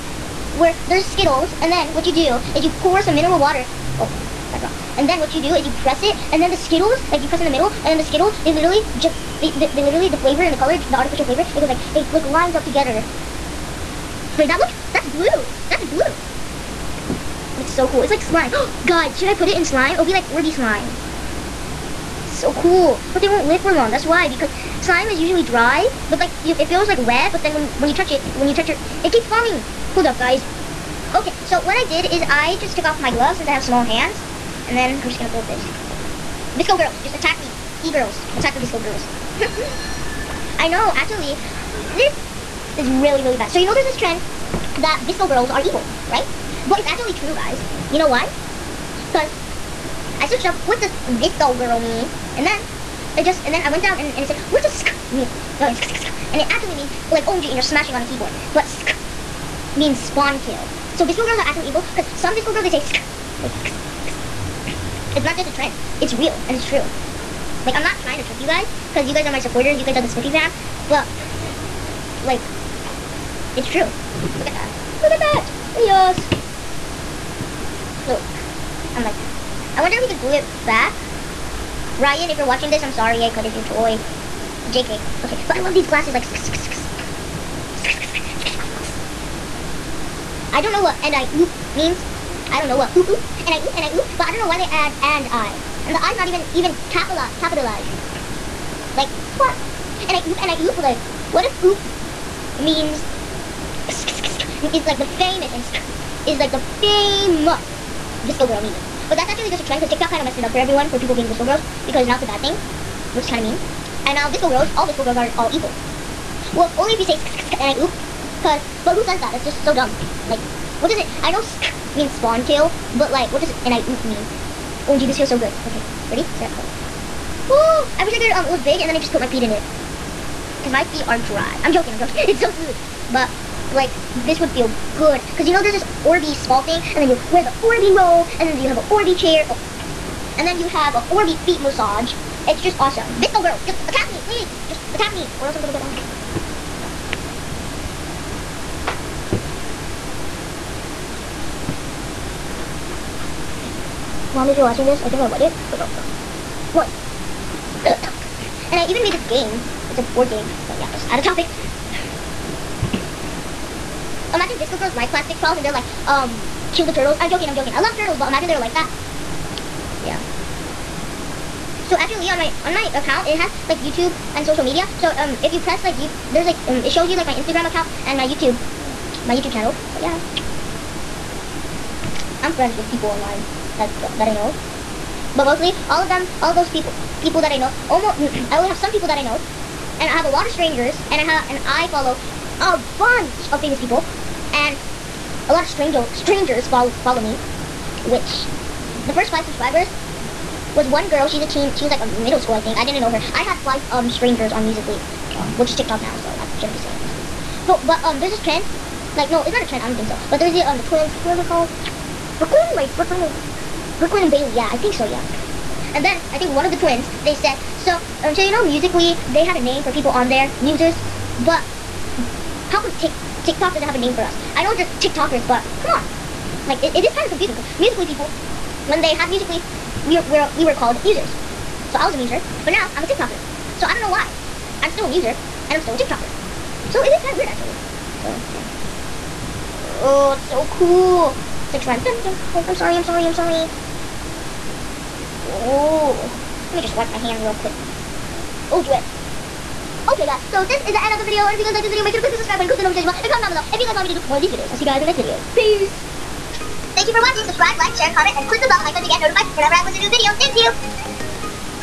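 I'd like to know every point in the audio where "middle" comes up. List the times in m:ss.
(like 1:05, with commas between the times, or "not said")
0:07, 3:22.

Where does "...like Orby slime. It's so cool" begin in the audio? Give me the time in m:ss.
0:20.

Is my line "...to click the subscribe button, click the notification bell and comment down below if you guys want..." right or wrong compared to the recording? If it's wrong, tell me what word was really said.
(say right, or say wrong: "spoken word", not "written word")
right.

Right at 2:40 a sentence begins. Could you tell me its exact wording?
But yeah, let's add a topic.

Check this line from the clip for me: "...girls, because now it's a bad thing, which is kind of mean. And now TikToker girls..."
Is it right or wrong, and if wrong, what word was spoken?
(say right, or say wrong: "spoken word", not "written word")
wrong: "VSCO", not "TikToker".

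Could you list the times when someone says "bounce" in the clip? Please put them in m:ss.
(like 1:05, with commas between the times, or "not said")
not said.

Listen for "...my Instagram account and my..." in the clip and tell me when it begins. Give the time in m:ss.
2:57.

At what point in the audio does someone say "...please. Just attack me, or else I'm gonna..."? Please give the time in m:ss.
2:24.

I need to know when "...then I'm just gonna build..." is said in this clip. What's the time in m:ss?
0:34.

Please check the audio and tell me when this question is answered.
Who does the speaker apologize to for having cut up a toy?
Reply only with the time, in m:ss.
1:21.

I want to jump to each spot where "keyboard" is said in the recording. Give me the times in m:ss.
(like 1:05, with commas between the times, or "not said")
0:58.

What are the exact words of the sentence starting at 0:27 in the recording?
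But then when when you touch it, when you touch it, it keeps falling.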